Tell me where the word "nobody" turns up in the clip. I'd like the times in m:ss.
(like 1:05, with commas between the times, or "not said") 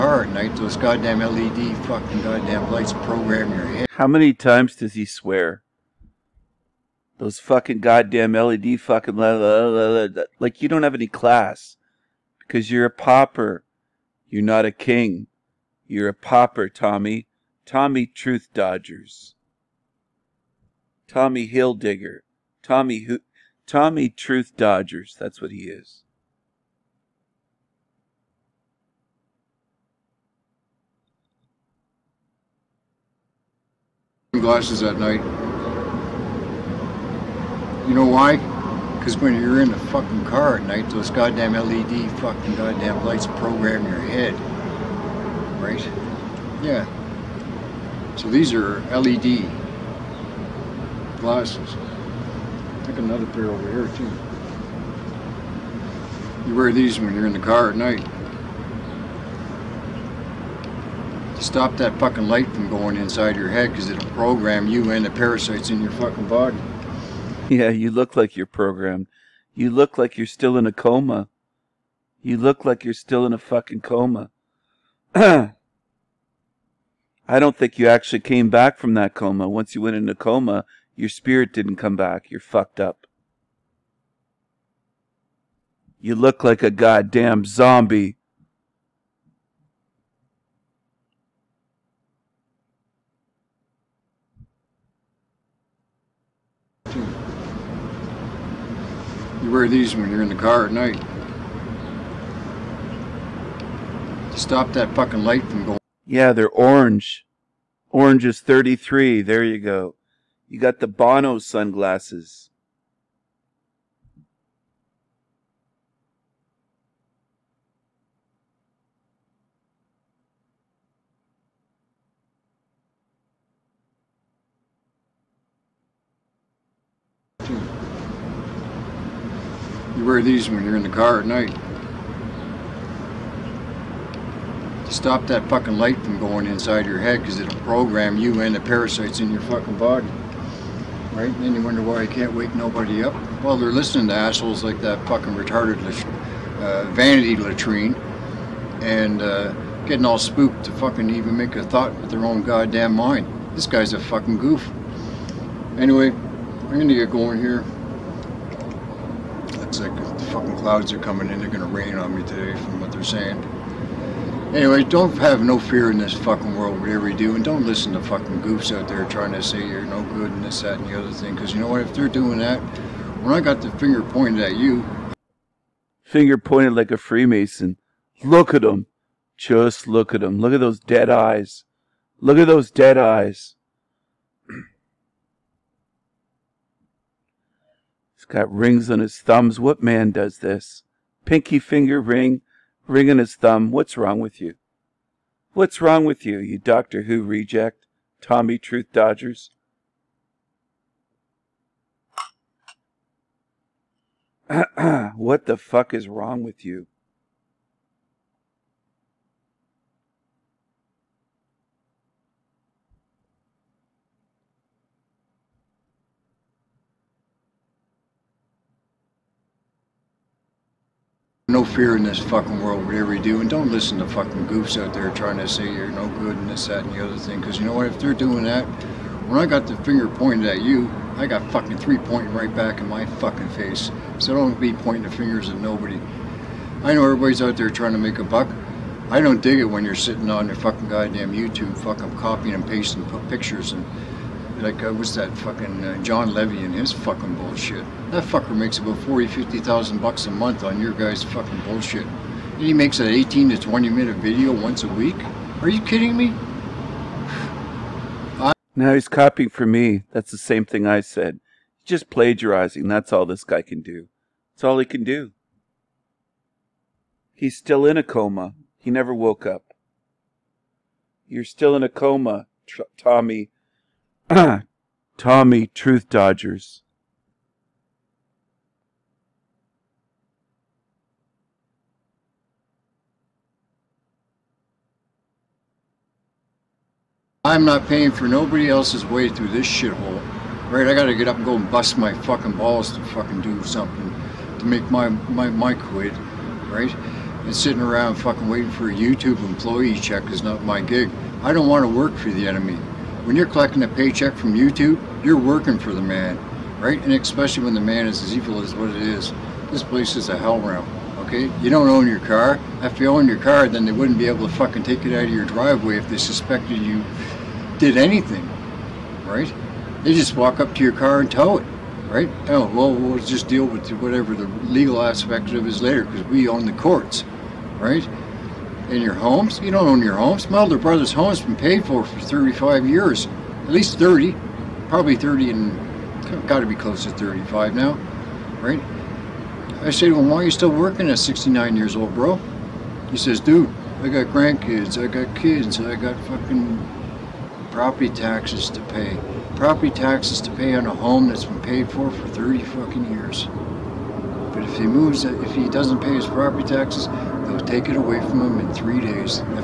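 2:22, 3:55, 4:48.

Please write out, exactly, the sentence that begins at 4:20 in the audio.
That's the same thing I said.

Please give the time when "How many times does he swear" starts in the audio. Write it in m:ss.
0:03.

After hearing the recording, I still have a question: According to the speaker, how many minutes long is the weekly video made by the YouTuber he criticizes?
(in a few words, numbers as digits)
18 to 20 minutes.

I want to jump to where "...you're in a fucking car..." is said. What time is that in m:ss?
0:39.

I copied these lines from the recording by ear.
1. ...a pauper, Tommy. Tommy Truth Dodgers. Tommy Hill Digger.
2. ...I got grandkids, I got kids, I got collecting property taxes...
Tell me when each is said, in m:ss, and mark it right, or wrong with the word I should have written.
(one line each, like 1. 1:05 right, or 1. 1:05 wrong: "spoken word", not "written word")
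1. 0:16 right
2. 5:44 wrong: "fucking", not "collecting".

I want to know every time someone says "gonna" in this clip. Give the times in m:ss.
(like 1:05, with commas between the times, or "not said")
2:36, 2:41.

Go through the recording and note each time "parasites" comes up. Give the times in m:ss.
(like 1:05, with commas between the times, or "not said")
1:05, 2:18.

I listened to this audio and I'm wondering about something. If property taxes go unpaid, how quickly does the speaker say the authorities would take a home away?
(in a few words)
3 days.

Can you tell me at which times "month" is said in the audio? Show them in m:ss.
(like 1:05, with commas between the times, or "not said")
4:10.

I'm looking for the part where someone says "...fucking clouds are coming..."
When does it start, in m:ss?
2:40.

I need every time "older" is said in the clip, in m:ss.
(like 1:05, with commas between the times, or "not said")
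5:30.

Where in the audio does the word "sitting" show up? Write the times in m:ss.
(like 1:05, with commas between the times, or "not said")
3:59, 4:57.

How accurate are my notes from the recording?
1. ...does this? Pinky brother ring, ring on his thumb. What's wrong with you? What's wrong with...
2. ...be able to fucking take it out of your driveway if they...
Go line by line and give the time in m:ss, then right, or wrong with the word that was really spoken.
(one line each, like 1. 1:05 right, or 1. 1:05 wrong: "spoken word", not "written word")
1. 3:10 wrong: "finger", not "brother"
2. 5:14 right.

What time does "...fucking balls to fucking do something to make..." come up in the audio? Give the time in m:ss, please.
4:52.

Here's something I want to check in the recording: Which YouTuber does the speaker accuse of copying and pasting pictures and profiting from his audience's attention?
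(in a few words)
John Levy.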